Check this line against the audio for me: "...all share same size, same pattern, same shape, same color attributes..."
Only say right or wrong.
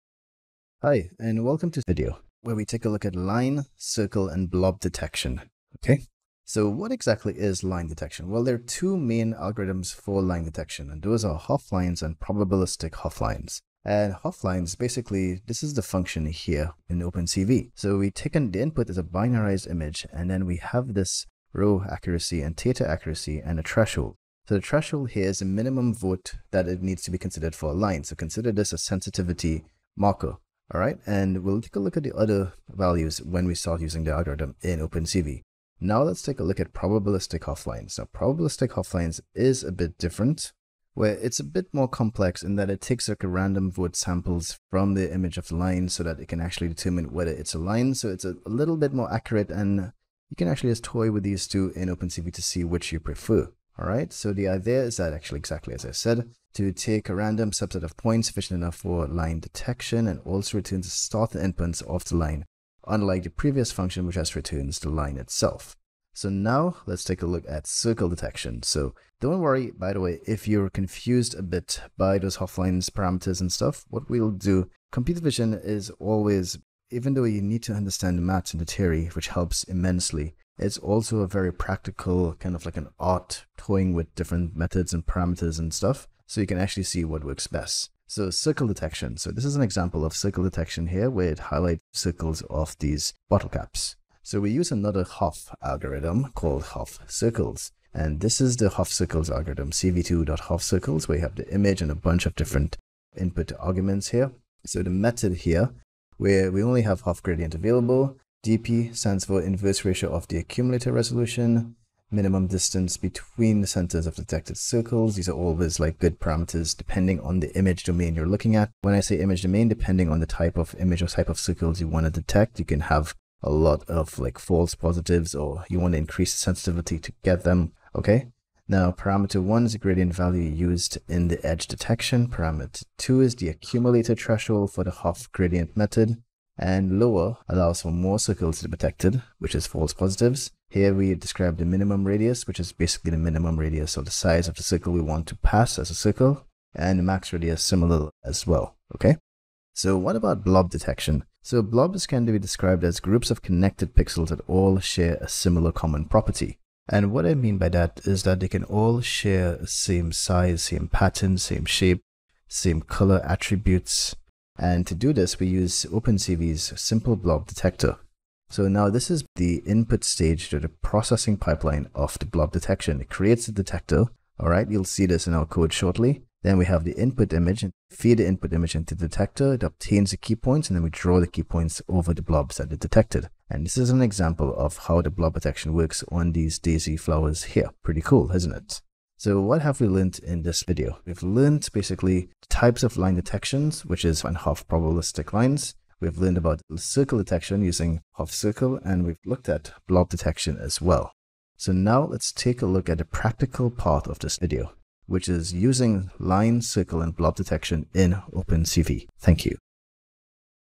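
right.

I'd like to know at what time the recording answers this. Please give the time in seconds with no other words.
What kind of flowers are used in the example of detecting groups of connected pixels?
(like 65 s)
186 s.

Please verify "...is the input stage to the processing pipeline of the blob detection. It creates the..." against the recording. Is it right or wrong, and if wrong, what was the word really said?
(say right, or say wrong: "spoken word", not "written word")
right.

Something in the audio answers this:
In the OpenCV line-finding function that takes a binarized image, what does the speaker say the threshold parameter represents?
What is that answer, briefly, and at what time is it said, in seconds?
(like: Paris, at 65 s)
Minimum vote, at 25 s.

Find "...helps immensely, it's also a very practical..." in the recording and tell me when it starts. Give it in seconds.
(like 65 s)
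79 s.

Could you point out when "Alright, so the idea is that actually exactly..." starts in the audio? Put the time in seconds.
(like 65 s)
53 s.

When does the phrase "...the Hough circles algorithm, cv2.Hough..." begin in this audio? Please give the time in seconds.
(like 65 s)
98 s.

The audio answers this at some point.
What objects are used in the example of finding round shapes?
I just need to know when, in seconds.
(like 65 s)
93 s.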